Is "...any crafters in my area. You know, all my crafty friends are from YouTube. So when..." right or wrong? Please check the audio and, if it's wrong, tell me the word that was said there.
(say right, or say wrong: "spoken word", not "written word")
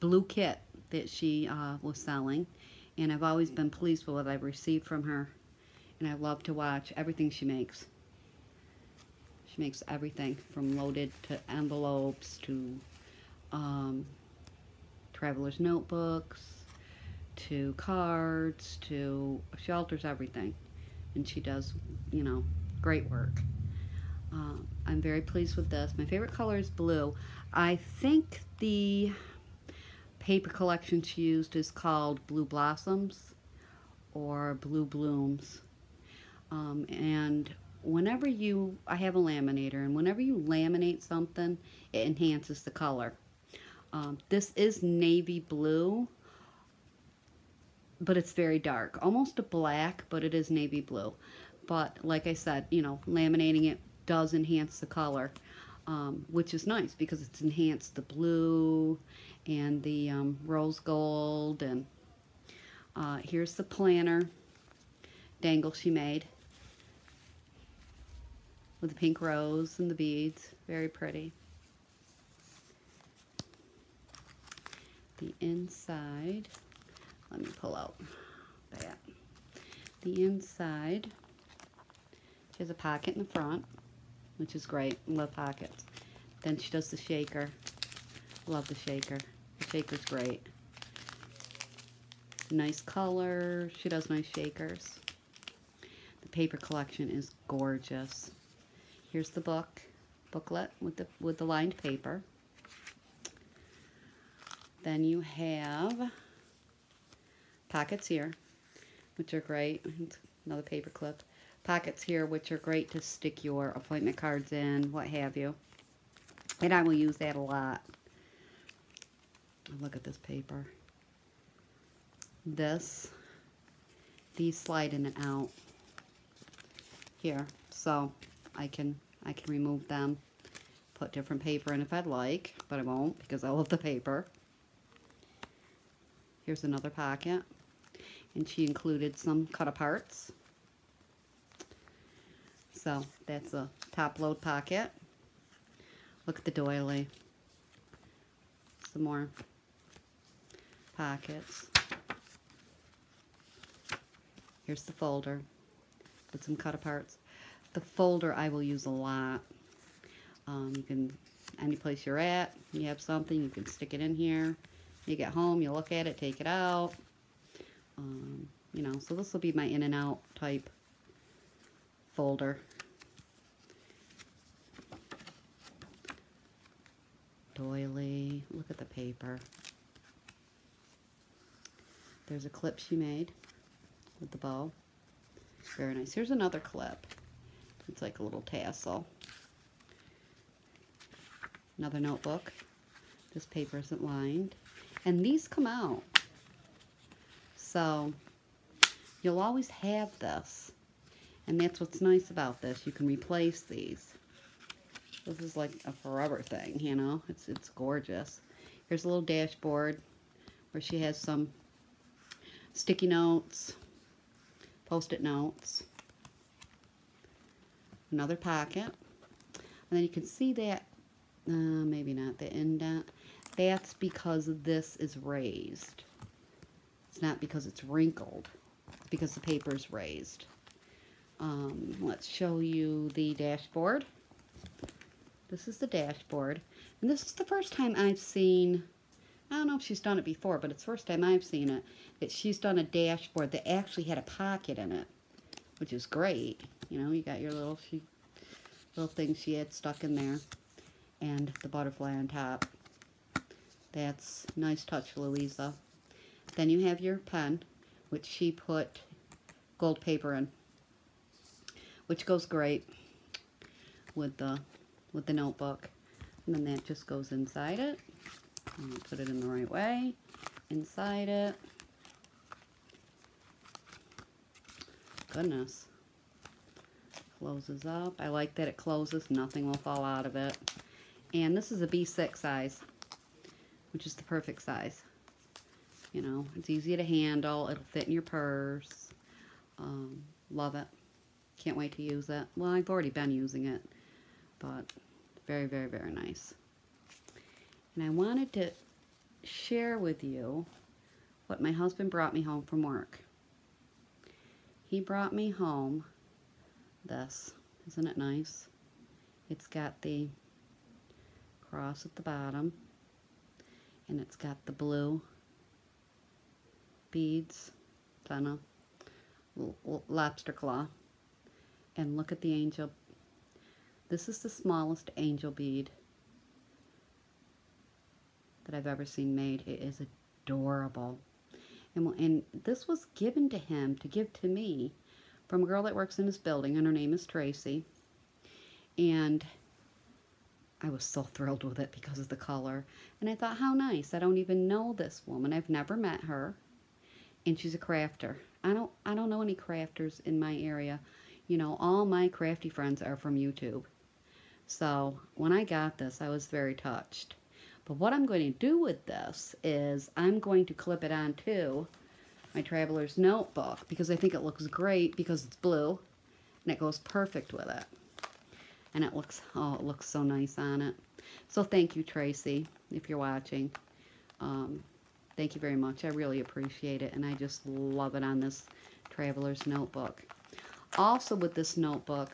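right.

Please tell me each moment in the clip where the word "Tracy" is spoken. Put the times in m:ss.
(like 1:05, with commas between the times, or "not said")
5:37, 6:12.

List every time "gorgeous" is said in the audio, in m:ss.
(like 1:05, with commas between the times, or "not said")
1:37, 3:27.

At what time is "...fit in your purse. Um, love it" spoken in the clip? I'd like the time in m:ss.
4:47.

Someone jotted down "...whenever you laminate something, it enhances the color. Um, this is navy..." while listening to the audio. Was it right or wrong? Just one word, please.
right.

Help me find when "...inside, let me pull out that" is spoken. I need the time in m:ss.
1:15.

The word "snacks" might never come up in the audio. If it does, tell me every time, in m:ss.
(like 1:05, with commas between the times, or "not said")
not said.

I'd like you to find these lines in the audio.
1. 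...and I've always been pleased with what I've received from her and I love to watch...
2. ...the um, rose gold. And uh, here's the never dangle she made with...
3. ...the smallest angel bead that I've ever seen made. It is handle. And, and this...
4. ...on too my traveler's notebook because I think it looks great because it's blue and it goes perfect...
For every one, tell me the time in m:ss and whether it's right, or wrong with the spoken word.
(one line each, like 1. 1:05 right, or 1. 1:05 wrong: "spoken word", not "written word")
1. 0:02 right
2. 0:59 wrong: "planner", not "never"
3. 5:24 wrong: "adorable", not "handle"
4. 6:01 right.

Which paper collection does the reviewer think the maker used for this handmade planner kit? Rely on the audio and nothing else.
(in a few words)
Blue Blossoms.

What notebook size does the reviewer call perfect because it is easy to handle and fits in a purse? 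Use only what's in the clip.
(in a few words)
B6.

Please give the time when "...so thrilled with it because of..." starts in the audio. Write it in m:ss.
5:41.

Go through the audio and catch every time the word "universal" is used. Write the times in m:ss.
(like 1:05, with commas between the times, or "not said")
not said.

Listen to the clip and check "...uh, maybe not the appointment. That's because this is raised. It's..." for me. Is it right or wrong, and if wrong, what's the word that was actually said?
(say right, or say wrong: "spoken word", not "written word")
wrong: "indent", not "appointment".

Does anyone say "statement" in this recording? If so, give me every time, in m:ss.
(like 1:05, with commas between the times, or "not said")
not said.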